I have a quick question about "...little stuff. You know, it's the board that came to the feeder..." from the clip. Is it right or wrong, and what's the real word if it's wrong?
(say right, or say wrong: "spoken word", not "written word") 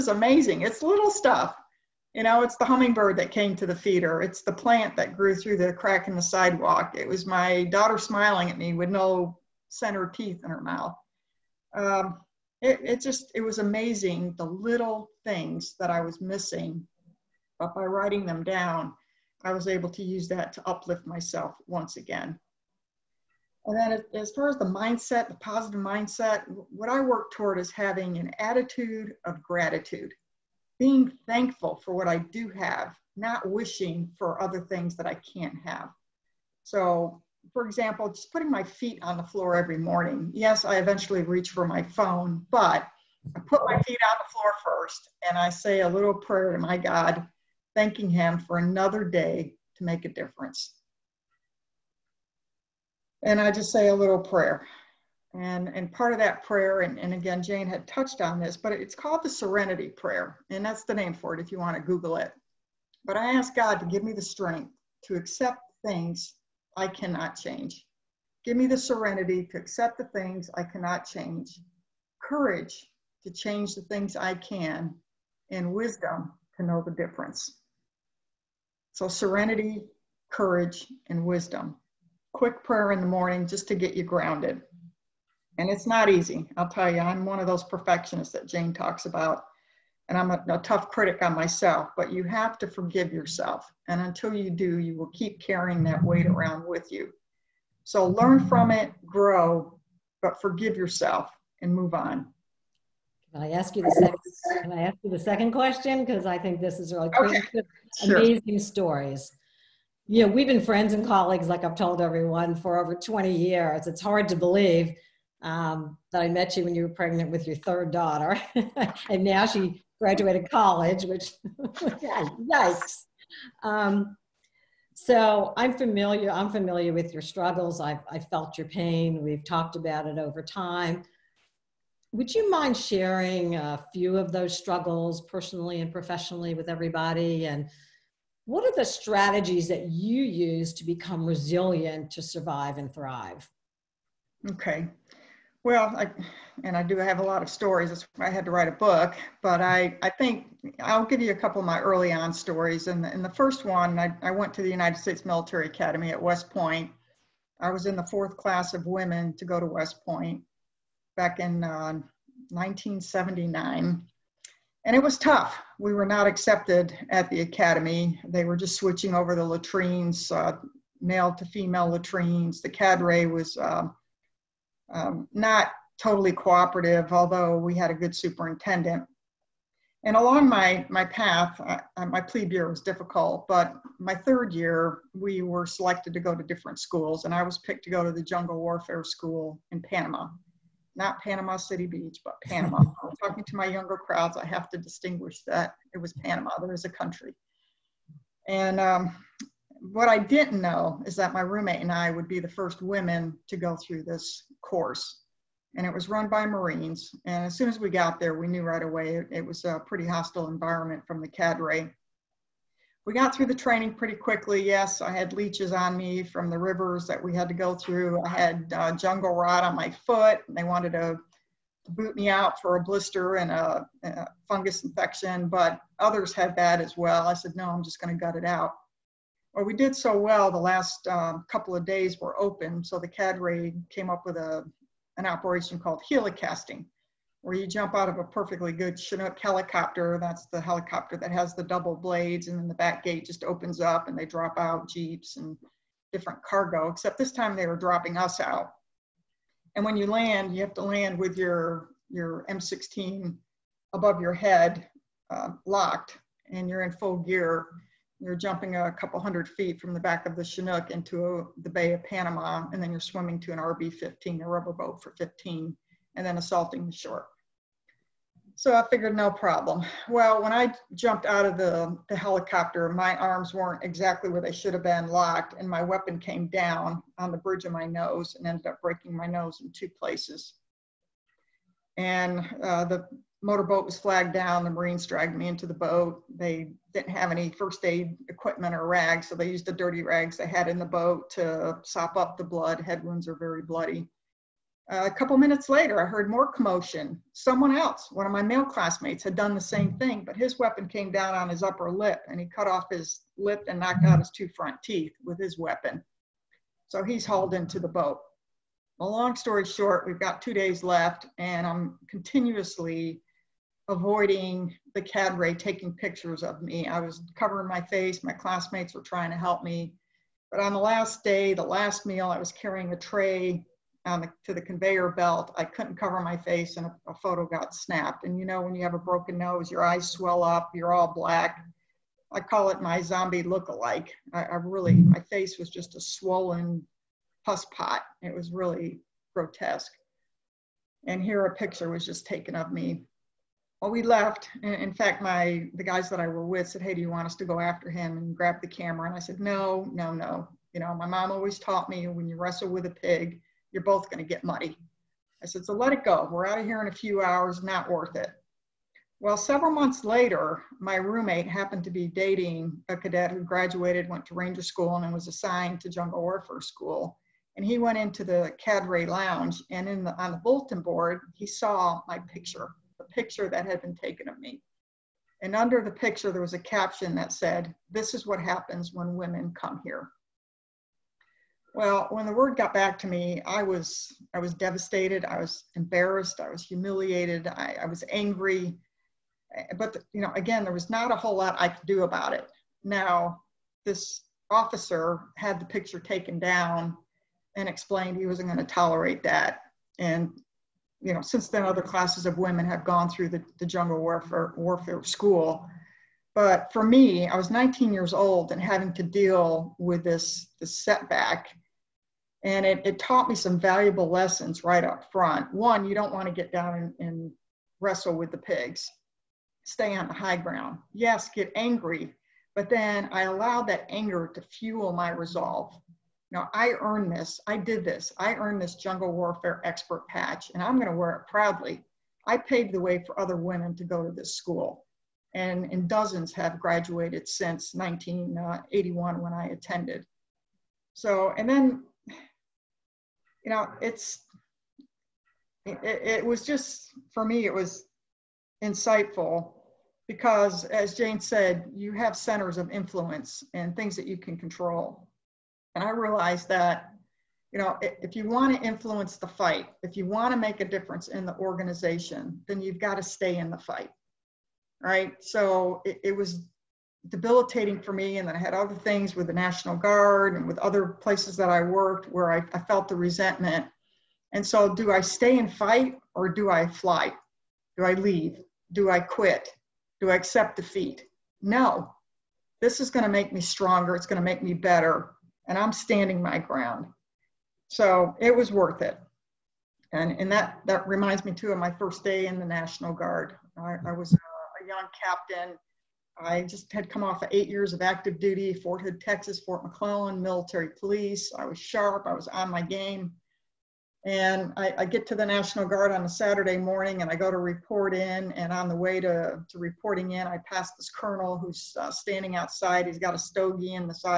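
wrong: "hummingbird", not "board".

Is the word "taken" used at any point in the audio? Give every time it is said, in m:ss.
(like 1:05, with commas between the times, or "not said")
5:42, 6:13, 6:35.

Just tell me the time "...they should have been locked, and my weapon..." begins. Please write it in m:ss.
4:34.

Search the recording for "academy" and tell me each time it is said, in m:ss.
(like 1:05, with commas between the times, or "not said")
2:35, 2:47.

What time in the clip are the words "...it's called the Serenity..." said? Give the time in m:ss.
0:58.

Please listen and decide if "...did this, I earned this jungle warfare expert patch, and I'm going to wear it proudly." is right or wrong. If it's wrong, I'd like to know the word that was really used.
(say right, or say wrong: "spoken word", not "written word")
right.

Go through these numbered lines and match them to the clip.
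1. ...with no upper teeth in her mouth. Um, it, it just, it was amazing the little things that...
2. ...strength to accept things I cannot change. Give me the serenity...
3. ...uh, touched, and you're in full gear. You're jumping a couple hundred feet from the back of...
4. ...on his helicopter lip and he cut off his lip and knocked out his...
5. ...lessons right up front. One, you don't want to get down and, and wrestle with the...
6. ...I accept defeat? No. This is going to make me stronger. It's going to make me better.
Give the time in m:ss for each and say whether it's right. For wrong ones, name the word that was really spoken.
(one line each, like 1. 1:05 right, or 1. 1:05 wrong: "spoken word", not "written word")
1. 0:08 wrong: "center", not "upper"
2. 1:04 right
3. 4:15 wrong: "locked", not "touched"
4. 5:01 wrong: "upper", not "helicopter"
5. 6:54 right
6. 8:00 right.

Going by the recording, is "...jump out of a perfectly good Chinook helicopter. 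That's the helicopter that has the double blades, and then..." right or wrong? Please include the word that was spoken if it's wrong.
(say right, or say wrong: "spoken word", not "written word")
right.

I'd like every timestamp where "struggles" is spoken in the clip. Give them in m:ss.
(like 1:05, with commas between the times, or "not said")
2:07, 2:14.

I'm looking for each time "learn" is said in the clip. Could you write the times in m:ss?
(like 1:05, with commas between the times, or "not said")
1:38.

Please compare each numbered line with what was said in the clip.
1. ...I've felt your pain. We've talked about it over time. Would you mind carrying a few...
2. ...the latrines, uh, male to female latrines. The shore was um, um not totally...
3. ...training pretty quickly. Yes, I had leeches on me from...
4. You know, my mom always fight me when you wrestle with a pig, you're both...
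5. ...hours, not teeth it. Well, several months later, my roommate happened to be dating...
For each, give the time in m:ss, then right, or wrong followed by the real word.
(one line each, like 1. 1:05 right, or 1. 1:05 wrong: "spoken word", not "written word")
1. 2:08 wrong: "sharing", not "carrying"
2. 2:49 wrong: "cadre", not "shore"
3. 3:33 right
4. 5:50 wrong: "taught", not "fight"
5. 5:57 wrong: "worth", not "teeth".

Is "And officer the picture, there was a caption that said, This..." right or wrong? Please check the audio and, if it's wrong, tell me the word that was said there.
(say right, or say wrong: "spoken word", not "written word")
wrong: "under", not "officer".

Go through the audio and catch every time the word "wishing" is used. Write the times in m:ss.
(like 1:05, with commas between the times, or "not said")
0:33.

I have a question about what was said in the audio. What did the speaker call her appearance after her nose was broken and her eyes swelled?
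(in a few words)
zombie look-alike.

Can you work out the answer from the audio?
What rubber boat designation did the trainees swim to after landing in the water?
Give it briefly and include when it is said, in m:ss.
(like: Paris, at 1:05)
RB 15, at 4:23.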